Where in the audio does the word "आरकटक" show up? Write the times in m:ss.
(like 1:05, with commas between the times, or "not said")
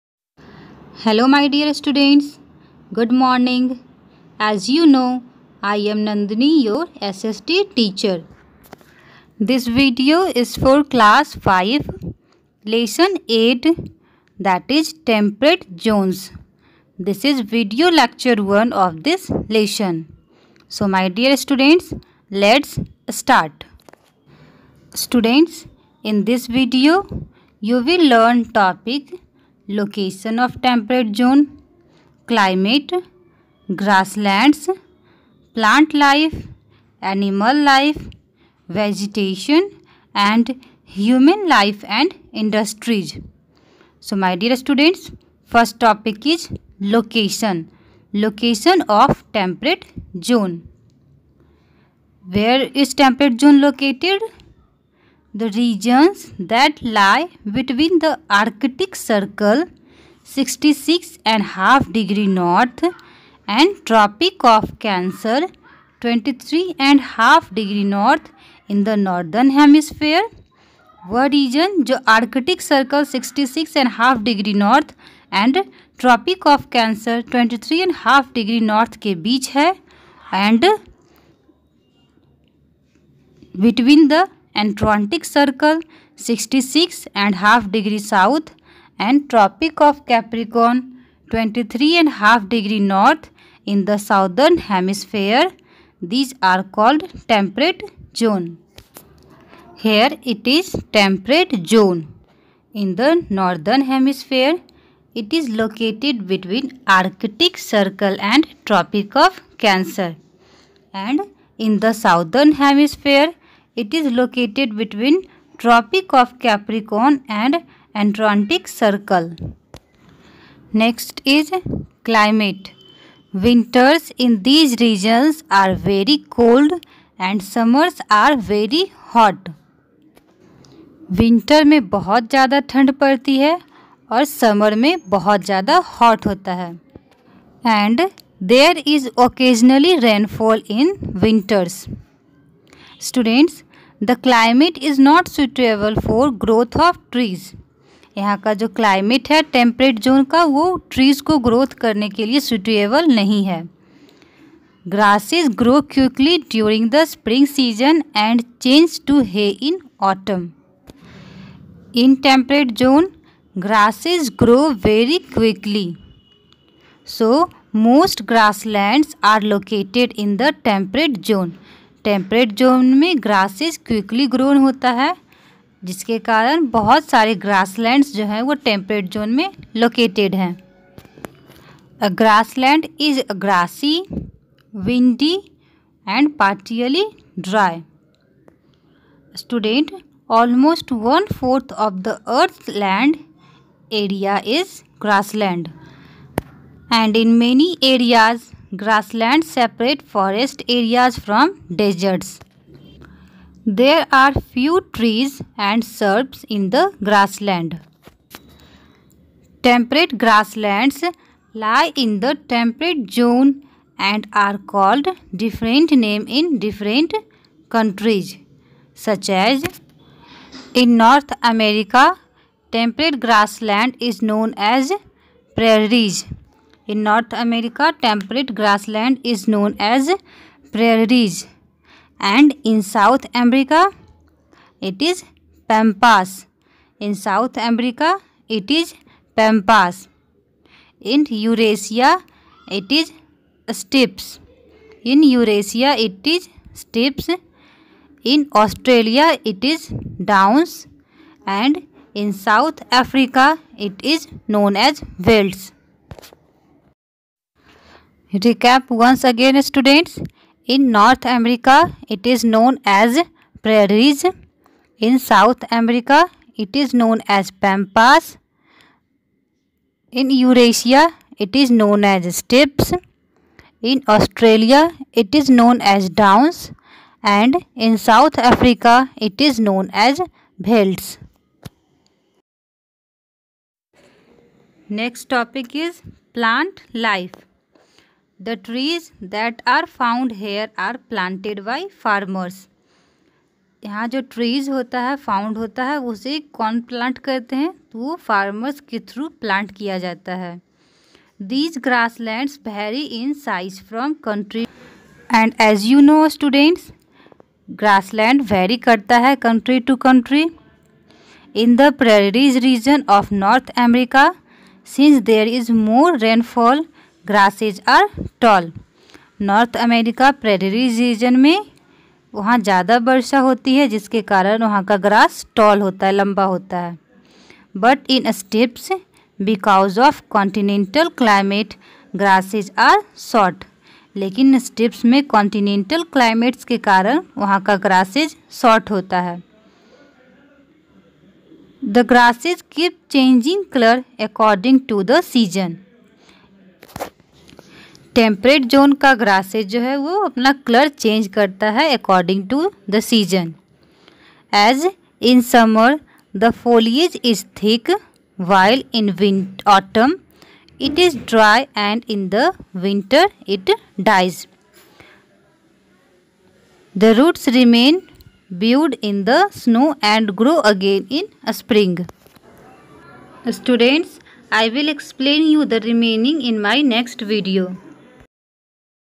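1:12.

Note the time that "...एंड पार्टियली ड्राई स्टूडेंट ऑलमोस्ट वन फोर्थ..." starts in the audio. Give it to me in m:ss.
3:06.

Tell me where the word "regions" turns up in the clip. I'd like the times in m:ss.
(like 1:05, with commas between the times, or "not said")
0:55.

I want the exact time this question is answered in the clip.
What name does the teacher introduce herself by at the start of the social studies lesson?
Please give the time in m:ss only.
0:06.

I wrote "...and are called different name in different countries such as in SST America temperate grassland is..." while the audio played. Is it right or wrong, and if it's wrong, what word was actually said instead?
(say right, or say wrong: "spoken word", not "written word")
wrong: "North", not "SST".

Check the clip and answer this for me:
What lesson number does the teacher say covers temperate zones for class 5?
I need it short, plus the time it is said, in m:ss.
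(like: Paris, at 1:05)
8, at 0:12.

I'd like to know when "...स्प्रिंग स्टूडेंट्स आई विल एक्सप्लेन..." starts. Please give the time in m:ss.
6:11.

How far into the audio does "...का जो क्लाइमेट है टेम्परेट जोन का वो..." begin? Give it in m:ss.
2:28.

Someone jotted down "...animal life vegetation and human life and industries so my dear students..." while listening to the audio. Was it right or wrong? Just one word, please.
right.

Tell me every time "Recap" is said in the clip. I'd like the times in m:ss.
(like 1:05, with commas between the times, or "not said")
4:18.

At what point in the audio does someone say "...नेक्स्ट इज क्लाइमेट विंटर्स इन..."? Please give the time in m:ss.
2:00.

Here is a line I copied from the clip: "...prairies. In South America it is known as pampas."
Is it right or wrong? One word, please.
right.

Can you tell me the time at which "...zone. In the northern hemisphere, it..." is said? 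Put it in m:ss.
1:41.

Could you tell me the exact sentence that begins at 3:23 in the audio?
There are few trees and shrubs in the grassland.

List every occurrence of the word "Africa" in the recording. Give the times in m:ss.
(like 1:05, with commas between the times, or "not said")
4:12, 4:38.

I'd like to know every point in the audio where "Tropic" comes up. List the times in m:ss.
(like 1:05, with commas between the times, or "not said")
1:03, 1:29, 1:48.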